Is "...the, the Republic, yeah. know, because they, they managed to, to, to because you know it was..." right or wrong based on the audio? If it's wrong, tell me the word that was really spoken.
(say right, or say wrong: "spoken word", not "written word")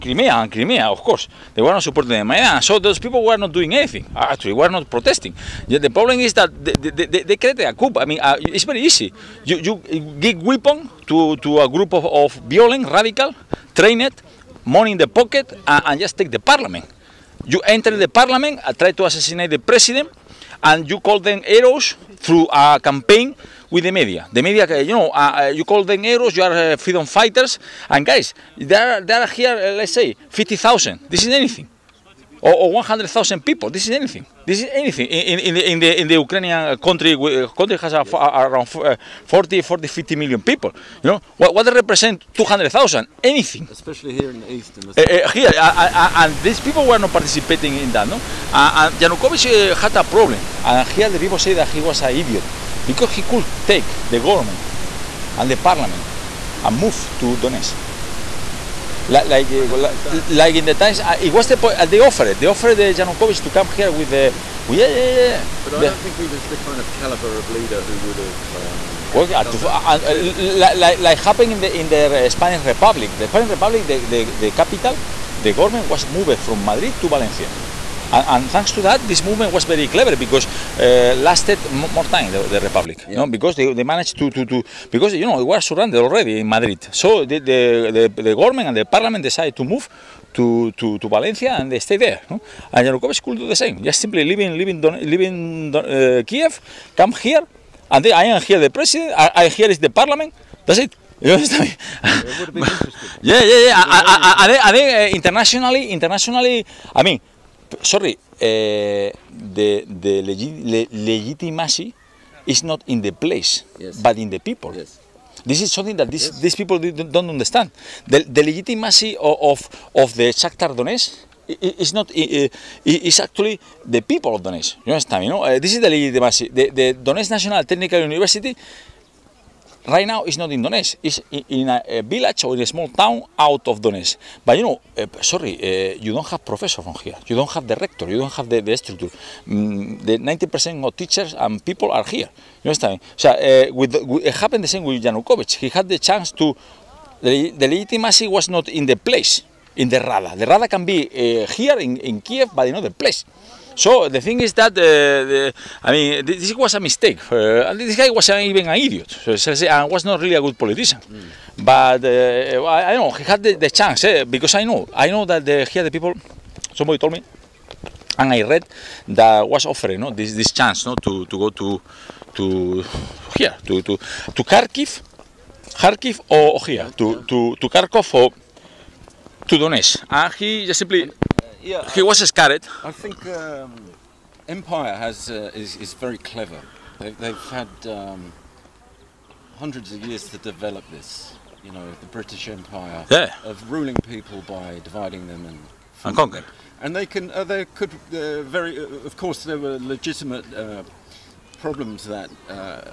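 right.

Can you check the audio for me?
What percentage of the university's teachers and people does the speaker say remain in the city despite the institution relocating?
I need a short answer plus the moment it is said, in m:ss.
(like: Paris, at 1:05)
90%, at 2:20.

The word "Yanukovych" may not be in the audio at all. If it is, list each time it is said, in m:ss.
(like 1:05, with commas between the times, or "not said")
0:48, 1:02, 1:32, 2:25.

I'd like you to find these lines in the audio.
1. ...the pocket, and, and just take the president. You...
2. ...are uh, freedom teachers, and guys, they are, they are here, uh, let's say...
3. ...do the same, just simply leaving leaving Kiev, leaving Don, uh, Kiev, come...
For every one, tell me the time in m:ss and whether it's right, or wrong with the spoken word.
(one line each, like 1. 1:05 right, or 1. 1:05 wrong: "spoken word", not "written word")
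1. 0:14 wrong: "parliament", not "president"
2. 0:26 wrong: "fighters", not "teachers"
3. 1:33 wrong: "Don", not "Kiev".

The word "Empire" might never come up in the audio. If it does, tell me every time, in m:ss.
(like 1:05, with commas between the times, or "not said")
3:04, 3:12.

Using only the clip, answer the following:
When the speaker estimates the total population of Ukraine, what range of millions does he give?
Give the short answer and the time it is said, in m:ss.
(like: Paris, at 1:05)
40-50 million, at 0:39.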